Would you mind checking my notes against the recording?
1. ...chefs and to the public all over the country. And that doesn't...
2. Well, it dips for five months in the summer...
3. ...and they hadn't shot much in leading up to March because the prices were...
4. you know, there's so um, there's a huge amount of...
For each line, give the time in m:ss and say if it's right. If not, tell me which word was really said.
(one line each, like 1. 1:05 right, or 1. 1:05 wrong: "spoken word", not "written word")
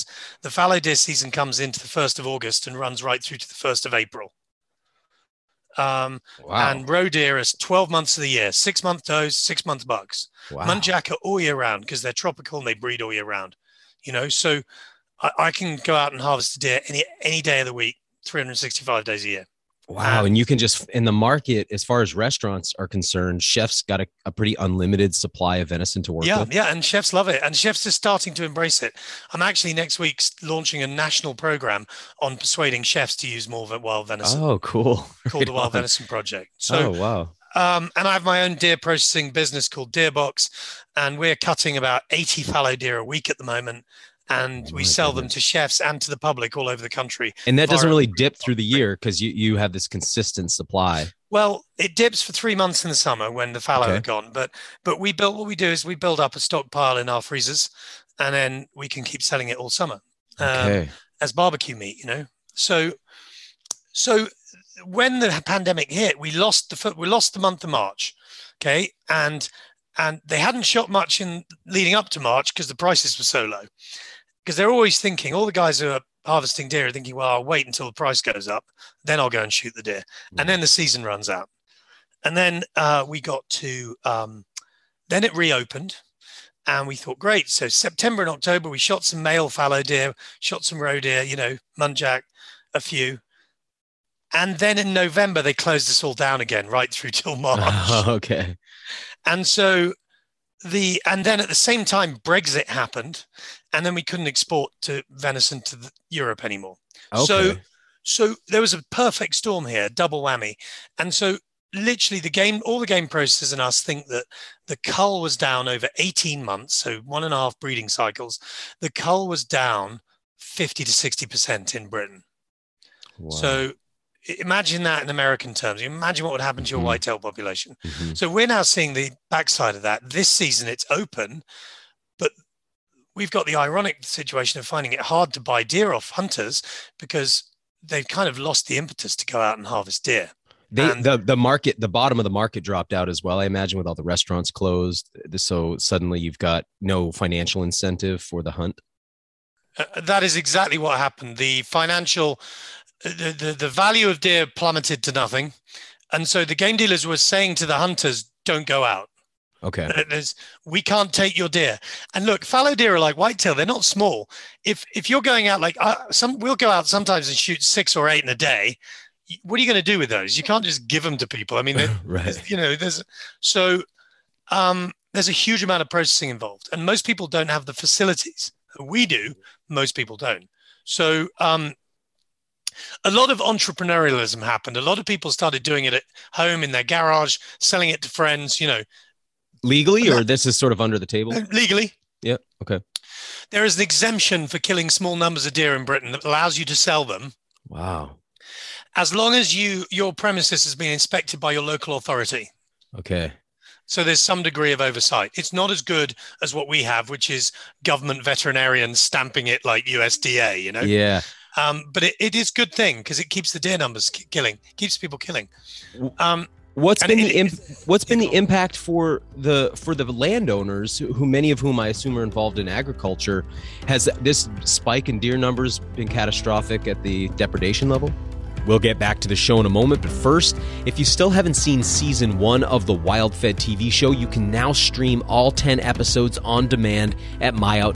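1. 0:45 right
2. 0:51 wrong: "three", not "five"
3. 1:09 right
4. 2:52 right.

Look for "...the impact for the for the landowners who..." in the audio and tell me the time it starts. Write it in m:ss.
3:38.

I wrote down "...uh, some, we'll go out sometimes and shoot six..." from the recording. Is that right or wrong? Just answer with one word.
right.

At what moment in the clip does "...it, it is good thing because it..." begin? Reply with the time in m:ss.
3:32.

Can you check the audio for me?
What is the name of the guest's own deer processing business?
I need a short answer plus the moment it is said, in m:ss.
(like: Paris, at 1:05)
Deerbox, at 0:39.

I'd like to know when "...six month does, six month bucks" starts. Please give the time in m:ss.
0:08.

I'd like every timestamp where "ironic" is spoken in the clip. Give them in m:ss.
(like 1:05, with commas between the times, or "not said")
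2:13.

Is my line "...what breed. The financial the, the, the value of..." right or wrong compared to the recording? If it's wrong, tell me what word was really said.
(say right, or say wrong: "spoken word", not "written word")
wrong: "happened", not "breed".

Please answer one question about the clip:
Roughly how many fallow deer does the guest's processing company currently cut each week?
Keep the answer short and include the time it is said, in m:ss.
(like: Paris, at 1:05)
80, at 0:42.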